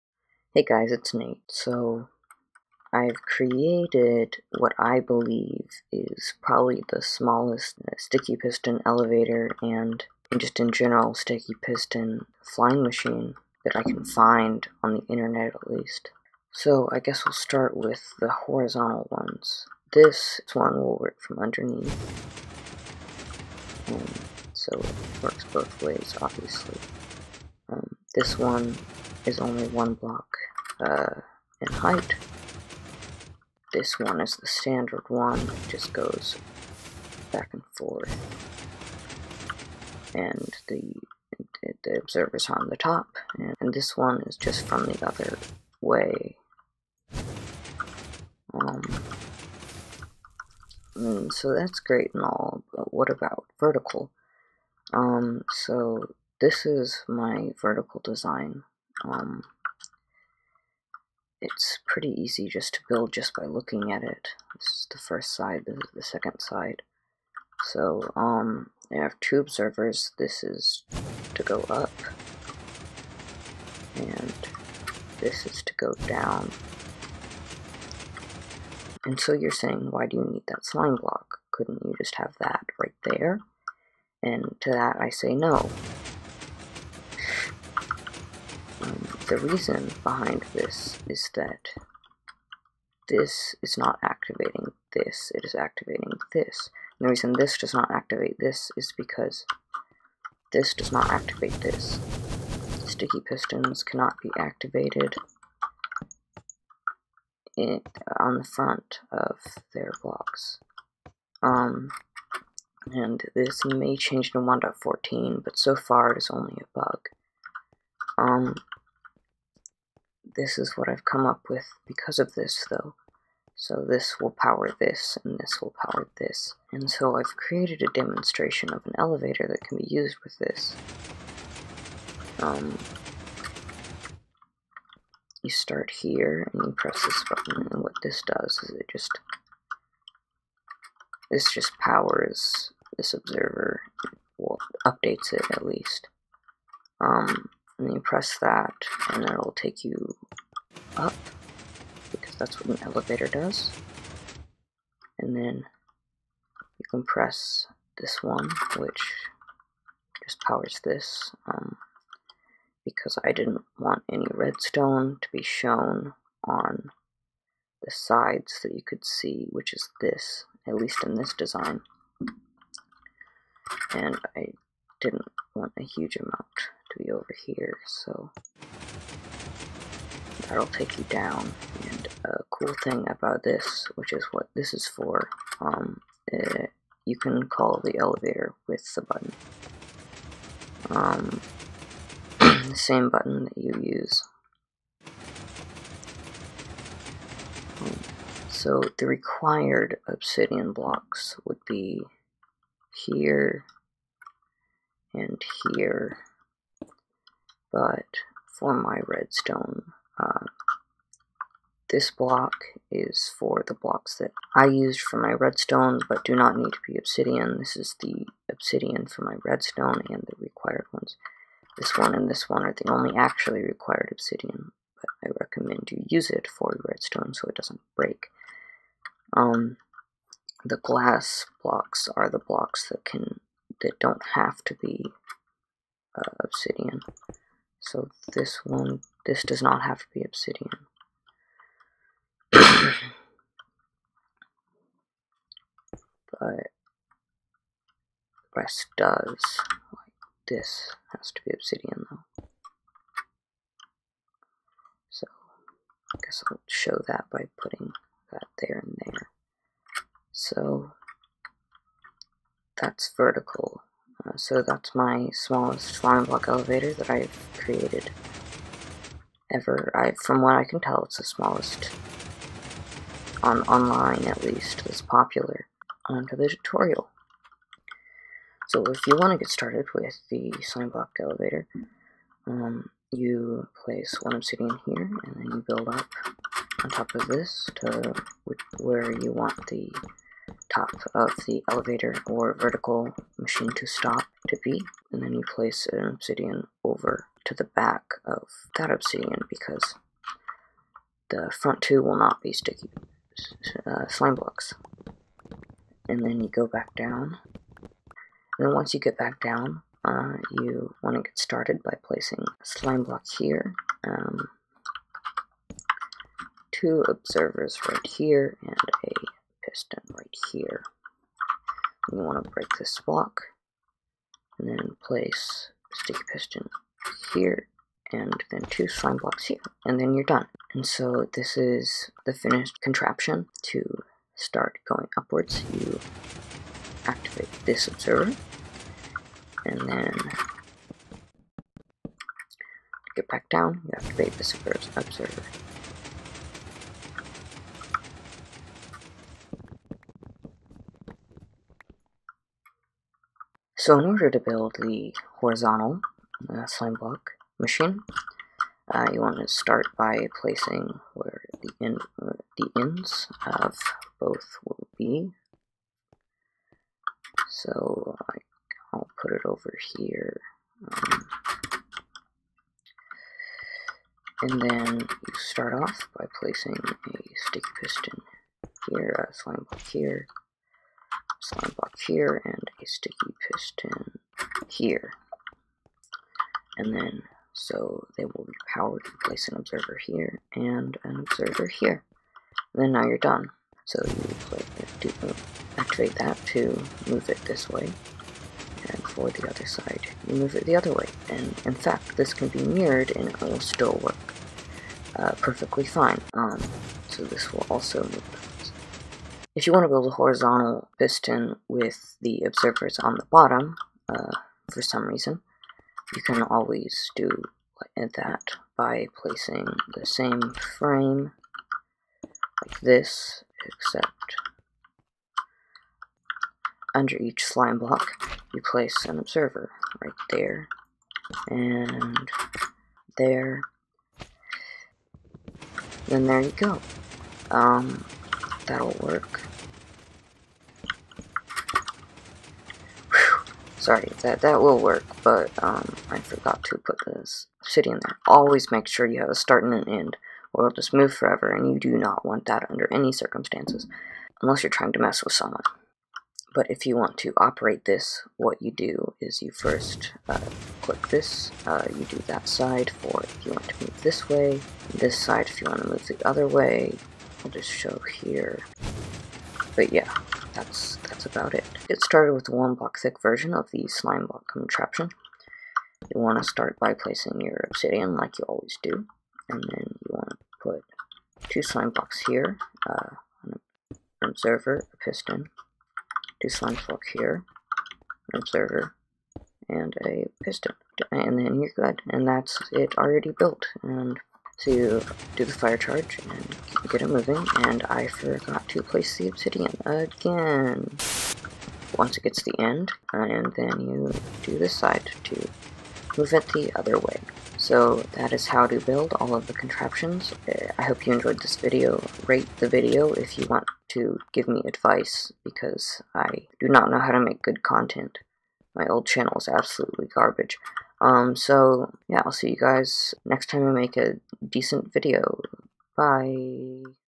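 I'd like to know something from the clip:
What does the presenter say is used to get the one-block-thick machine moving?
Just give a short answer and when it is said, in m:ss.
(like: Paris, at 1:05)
fire charge, at 8:15.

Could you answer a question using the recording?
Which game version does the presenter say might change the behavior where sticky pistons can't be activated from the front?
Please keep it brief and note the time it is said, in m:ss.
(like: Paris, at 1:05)
1.14, at 1:54.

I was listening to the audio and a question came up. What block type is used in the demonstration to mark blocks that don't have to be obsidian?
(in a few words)
glass blocks.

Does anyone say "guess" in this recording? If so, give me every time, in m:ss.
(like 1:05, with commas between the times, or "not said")
0:16, 4:16.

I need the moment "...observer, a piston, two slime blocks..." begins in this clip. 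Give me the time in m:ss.
8:04.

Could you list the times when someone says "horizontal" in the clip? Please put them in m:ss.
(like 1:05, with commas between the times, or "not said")
0:18, 5:55, 6:50.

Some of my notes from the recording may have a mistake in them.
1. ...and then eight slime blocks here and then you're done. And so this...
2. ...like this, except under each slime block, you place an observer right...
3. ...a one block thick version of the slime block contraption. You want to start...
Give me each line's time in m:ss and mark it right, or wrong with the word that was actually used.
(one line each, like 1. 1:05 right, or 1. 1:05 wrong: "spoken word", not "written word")
1. 5:28 wrong: "two", not "eight"
2. 7:02 right
3. 7:52 right.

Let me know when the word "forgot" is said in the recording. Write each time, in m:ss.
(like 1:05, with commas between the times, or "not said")
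7:26, 8:18.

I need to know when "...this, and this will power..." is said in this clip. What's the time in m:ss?
2:04.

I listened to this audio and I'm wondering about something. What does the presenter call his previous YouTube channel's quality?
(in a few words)
absolutely garbage.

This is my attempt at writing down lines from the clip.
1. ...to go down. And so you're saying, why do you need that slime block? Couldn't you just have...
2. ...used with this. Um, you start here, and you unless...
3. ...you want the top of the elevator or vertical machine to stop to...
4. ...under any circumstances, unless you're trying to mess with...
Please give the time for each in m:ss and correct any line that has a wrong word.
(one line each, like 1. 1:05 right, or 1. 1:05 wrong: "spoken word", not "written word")
1. 1:15 right
2. 2:09 wrong: "press", not "unless"
3. 4:49 right
4. 7:32 right.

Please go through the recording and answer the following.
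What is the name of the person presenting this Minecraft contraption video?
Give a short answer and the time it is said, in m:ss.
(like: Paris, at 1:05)
Nate, at 0:01.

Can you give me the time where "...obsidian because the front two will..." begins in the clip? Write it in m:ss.
4:58.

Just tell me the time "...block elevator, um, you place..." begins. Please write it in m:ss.
4:40.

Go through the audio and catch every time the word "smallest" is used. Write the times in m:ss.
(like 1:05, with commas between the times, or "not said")
0:07, 4:25, 4:31.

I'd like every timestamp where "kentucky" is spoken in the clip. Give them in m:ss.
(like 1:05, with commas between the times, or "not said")
not said.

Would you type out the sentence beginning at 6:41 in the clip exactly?
And in fact, this can be mirrored and it will still work uh, perfectly fine.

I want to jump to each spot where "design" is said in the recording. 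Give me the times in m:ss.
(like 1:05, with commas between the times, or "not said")
0:58, 2:51.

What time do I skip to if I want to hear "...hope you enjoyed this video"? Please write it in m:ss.
8:30.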